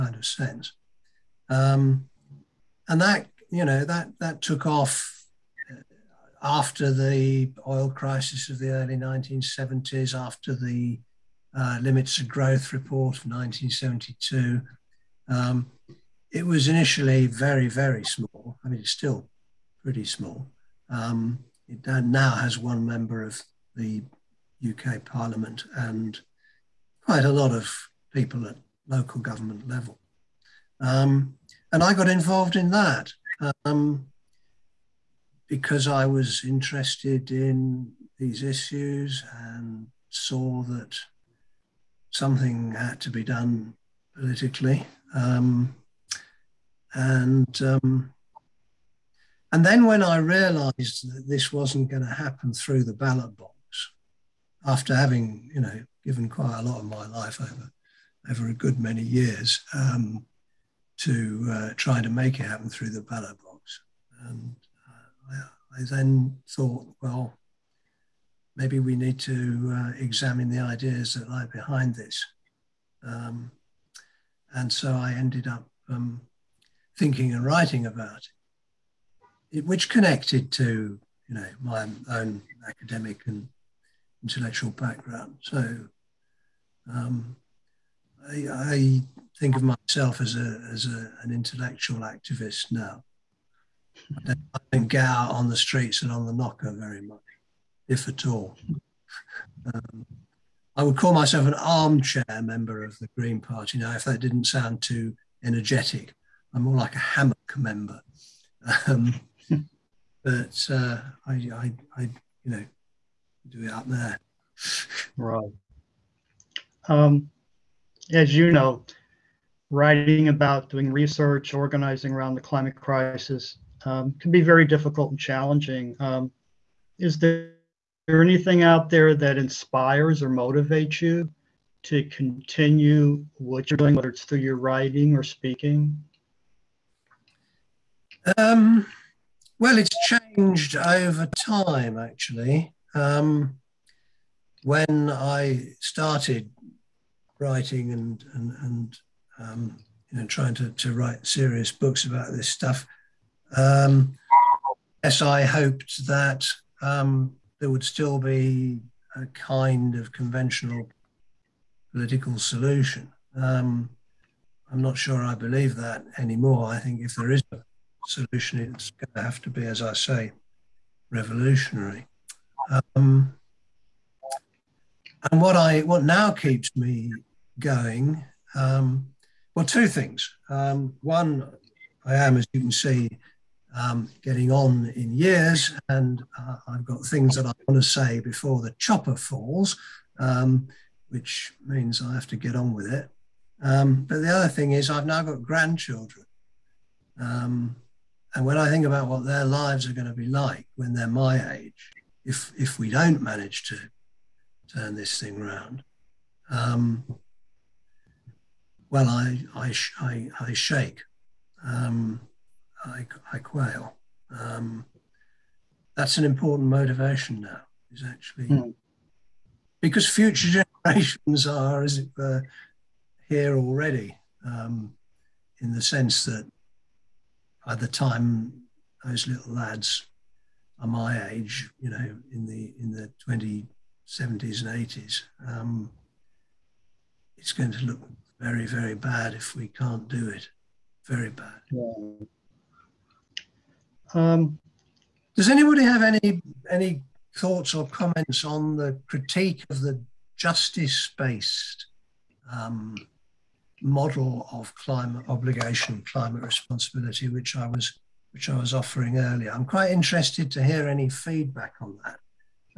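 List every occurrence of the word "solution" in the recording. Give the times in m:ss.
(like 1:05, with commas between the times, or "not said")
2:42, 2:48.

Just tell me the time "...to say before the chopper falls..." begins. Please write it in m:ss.
3:07.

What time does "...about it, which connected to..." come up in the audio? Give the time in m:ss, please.
1:17.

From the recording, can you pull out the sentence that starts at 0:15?
Um, it was initially very, very small.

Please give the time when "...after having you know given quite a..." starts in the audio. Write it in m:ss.
0:54.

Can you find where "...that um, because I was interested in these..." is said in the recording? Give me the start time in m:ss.
0:32.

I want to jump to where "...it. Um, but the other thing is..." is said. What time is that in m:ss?
3:12.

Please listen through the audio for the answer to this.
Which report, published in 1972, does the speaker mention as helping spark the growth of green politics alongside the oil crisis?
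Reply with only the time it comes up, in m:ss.
0:11.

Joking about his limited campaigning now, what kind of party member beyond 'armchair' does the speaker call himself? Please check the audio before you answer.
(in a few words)
hammock member.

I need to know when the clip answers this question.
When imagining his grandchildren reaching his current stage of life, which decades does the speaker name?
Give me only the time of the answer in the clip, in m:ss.
3:53.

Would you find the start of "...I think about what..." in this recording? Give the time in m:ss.
3:18.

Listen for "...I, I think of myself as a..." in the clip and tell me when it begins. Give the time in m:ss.
1:28.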